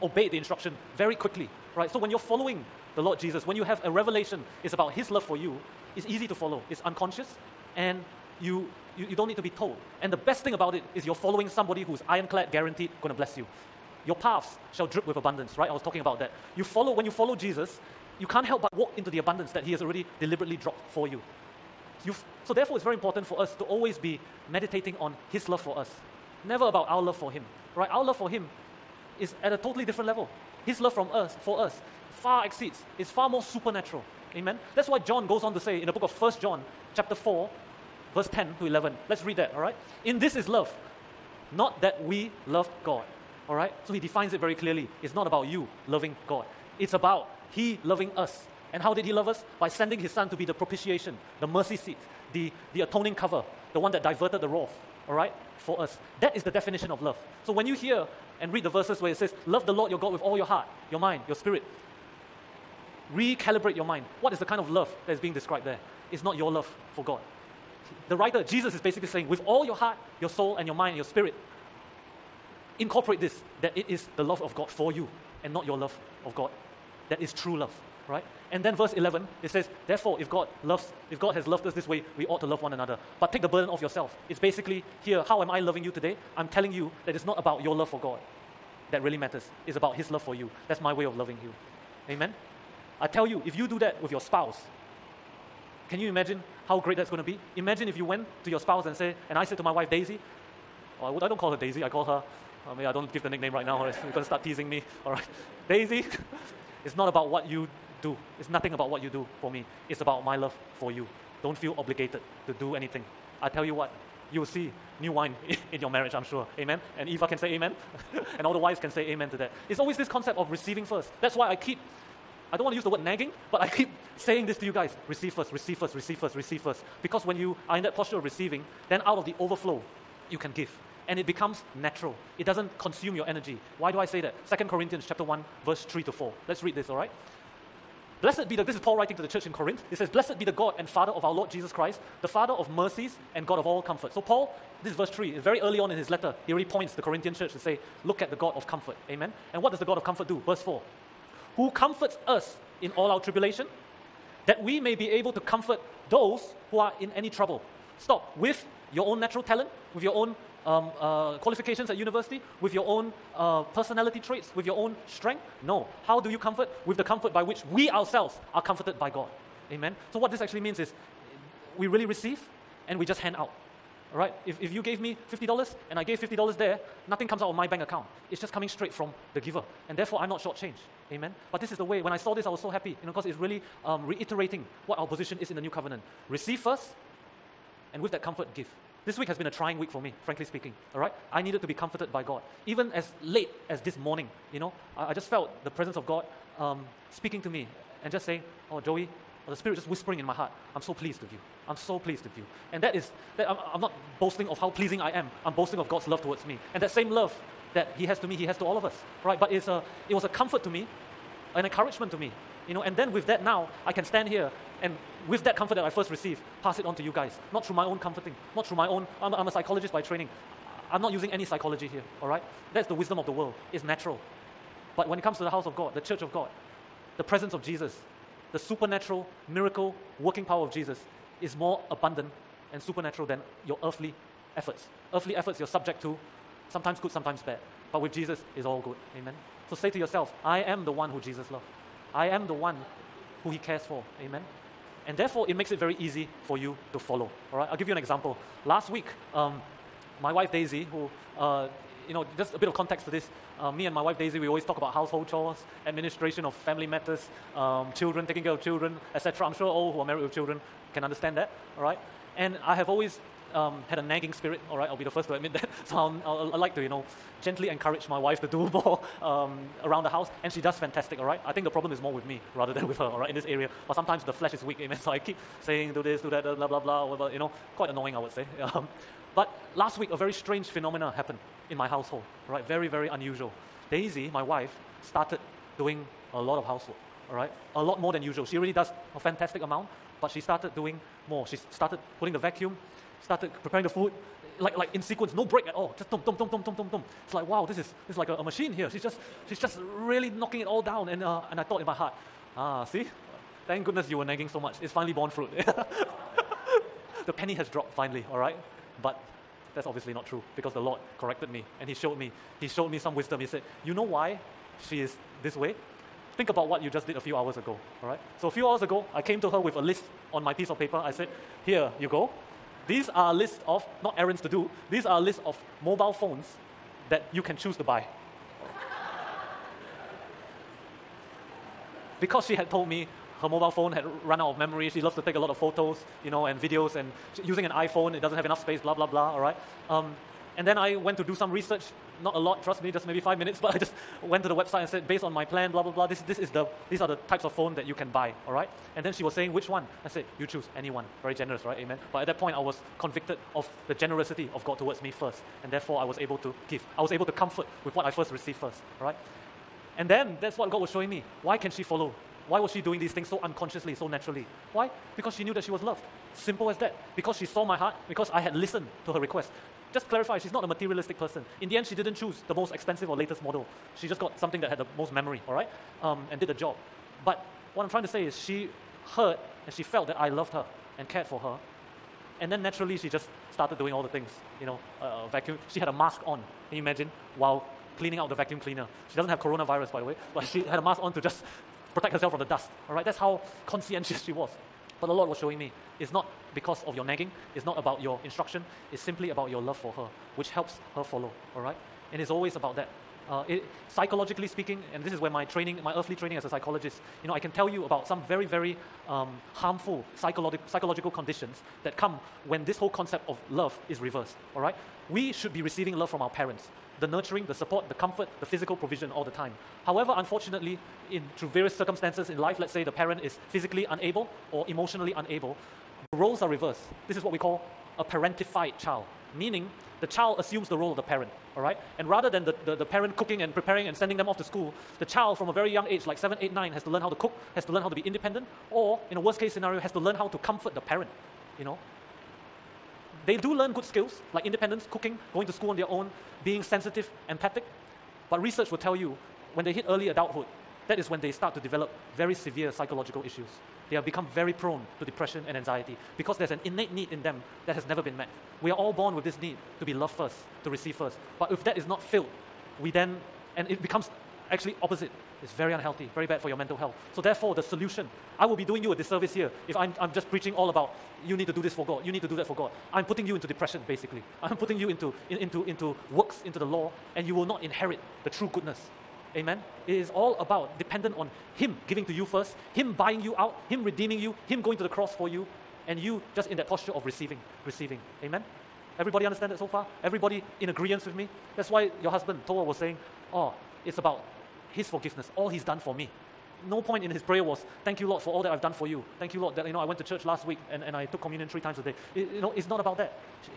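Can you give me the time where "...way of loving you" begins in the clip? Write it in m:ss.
1:30.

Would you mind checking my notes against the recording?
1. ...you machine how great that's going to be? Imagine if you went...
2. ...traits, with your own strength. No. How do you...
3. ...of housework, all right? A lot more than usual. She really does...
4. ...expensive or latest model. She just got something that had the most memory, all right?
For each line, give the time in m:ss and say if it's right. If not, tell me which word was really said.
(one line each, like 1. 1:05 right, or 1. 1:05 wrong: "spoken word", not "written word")
1. 1:35 wrong: "imagine", not "machine"
2. 2:44 right
3. 4:46 right
4. 6:12 right.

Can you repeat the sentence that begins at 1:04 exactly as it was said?
What is the kind of love that is being described there?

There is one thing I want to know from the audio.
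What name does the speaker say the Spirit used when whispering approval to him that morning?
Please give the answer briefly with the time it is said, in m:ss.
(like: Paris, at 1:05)
Joey, at 3:18.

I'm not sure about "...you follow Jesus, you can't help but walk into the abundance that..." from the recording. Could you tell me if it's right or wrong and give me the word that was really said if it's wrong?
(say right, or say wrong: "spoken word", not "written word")
right.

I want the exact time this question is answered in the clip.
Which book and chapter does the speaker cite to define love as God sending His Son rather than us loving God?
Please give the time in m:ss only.
0:36.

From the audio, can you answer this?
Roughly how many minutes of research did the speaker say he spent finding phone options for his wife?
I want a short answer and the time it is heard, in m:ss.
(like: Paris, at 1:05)
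5, at 5:43.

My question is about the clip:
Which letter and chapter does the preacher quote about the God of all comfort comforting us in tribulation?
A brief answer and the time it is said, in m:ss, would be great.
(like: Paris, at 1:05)
2 Corinthians chapter 1, at 2:14.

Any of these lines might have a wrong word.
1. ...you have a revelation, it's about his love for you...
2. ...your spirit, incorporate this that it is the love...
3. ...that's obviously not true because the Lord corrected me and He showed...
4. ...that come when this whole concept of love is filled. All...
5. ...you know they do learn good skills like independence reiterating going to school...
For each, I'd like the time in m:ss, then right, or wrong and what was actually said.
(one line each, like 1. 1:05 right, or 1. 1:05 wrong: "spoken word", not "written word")
1. 0:03 right
2. 1:10 right
3. 5:09 right
4. 6:51 wrong: "reversed", not "filled"
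5. 7:21 wrong: "cooking", not "reiterating".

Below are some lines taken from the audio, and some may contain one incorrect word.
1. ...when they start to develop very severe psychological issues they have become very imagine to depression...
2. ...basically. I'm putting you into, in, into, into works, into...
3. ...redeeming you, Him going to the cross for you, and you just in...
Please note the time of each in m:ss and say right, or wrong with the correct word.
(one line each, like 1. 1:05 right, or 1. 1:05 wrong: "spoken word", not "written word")
1. 7:31 wrong: "prone", not "imagine"
2. 7:53 right
3. 8:03 right.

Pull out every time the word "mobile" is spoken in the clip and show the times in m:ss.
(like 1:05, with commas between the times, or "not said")
5:25, 5:33.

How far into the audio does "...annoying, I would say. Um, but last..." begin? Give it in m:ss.
4:37.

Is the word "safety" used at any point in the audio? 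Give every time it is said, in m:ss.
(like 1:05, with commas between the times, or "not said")
not said.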